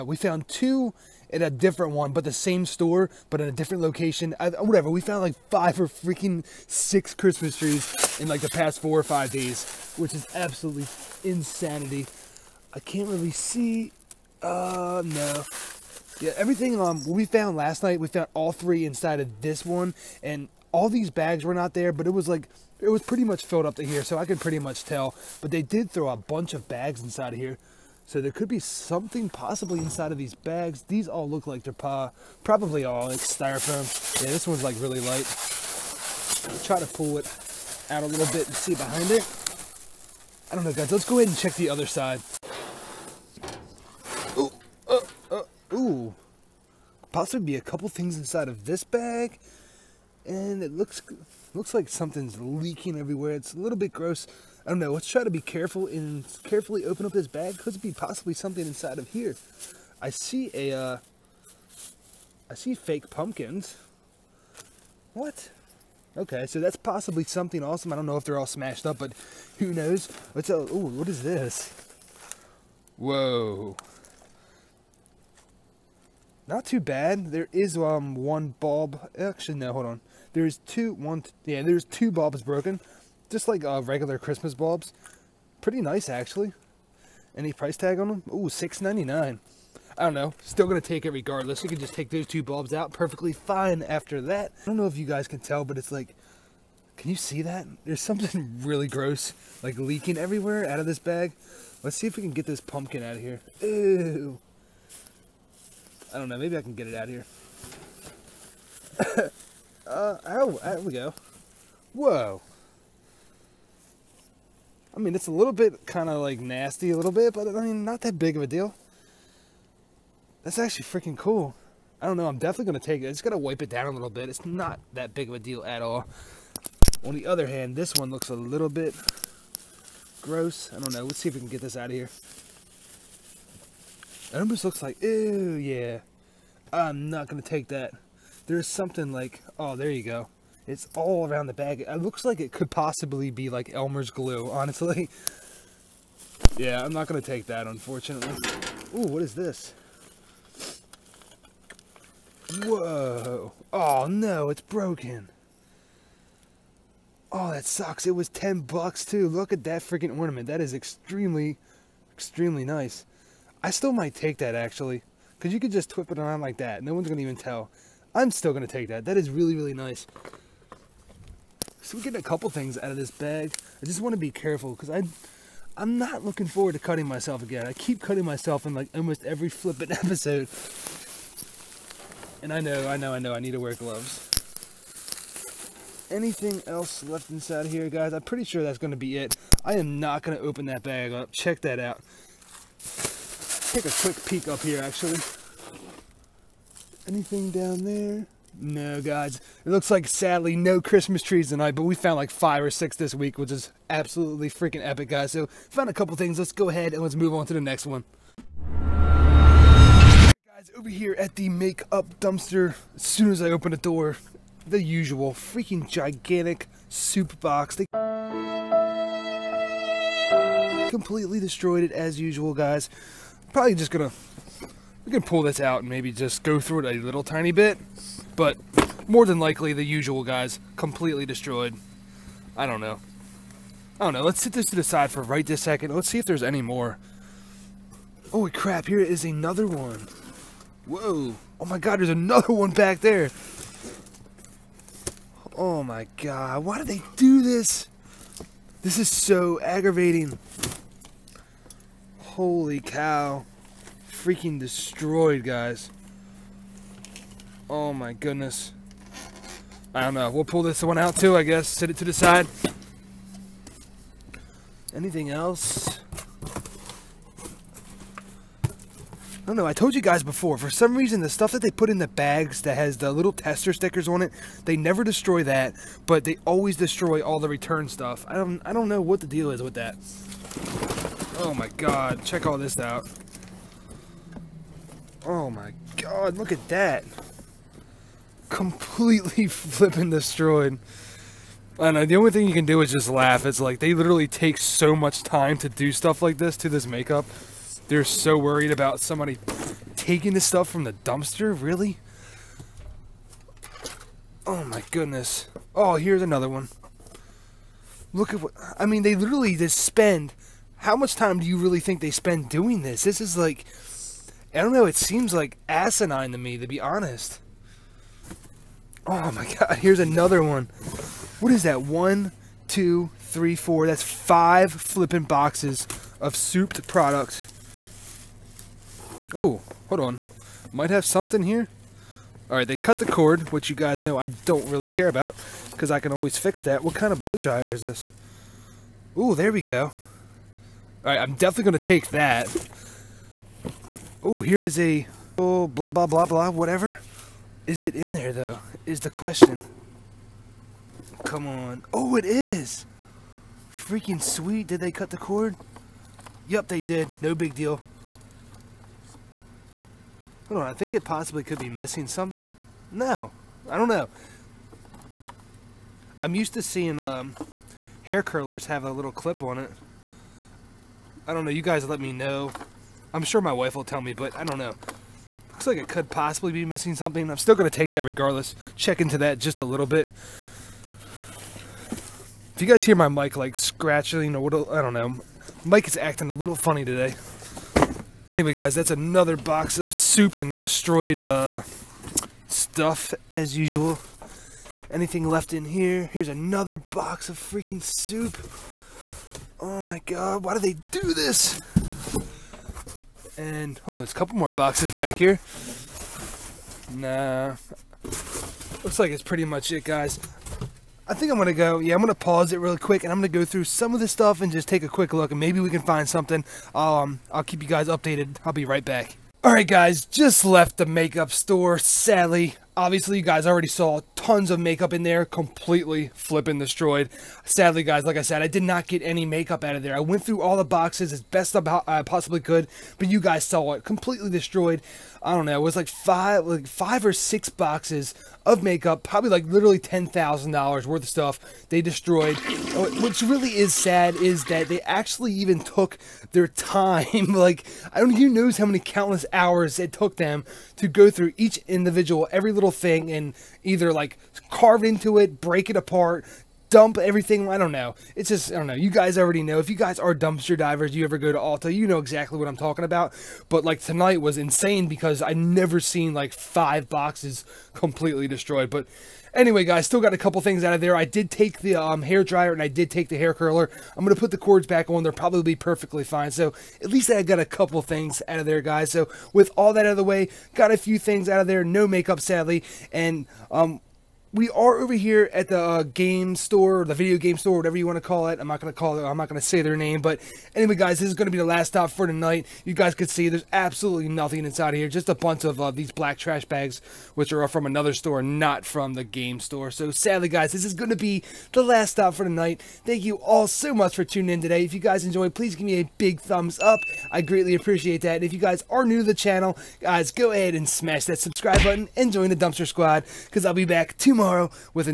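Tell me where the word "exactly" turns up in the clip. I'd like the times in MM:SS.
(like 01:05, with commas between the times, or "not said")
07:41.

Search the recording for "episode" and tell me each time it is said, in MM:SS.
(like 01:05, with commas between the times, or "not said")
02:59.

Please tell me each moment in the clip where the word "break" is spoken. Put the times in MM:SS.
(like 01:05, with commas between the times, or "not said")
07:35.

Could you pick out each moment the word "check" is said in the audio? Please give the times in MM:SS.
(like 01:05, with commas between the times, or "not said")
00:41, 03:11, 04:42, 06:18.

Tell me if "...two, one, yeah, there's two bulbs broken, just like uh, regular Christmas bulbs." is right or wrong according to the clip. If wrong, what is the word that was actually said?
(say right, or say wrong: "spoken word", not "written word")
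right.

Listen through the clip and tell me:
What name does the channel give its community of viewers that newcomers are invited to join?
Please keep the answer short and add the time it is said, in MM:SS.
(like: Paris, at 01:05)
Dumpster Squad, at 08:32.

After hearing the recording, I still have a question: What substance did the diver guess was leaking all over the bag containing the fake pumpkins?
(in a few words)
Elmer's glue.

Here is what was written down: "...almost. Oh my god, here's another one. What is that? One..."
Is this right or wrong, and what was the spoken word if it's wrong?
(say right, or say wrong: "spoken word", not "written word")
wrong: "honest", not "almost".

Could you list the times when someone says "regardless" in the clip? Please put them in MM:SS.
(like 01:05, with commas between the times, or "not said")
01:31, 06:18.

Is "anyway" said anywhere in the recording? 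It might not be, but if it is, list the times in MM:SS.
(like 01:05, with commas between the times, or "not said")
06:28, 07:49, 08:10.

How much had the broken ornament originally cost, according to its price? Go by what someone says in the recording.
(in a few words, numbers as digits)
10 bucks.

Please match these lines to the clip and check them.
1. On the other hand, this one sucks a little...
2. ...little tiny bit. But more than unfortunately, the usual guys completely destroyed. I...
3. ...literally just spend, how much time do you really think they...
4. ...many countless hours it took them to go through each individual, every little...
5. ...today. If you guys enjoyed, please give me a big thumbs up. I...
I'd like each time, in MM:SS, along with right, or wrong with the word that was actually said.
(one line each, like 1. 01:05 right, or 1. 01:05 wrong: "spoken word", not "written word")
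1. 02:07 wrong: "looks", not "sucks"
2. 03:46 wrong: "likely", not "unfortunately"
3. 05:09 right
4. 07:28 right
5. 08:24 right.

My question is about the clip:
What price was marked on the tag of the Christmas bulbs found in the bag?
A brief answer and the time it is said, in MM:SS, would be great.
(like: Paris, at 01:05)
$6.99, at 01:28.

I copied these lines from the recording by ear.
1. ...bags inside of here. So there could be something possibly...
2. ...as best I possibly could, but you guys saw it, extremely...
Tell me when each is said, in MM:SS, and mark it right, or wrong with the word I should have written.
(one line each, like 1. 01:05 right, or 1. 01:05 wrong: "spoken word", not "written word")
1. 00:26 right
2. 07:11 wrong: "completely", not "extremely".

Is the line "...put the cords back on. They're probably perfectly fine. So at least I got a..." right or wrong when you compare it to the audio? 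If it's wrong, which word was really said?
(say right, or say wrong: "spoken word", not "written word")
right.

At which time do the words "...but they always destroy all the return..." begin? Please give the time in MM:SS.
04:36.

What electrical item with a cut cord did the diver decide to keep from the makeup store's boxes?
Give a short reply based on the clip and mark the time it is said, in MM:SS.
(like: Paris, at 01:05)
Blow dryer, at 05:37.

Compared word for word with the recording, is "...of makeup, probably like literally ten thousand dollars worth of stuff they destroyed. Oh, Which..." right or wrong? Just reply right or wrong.
right.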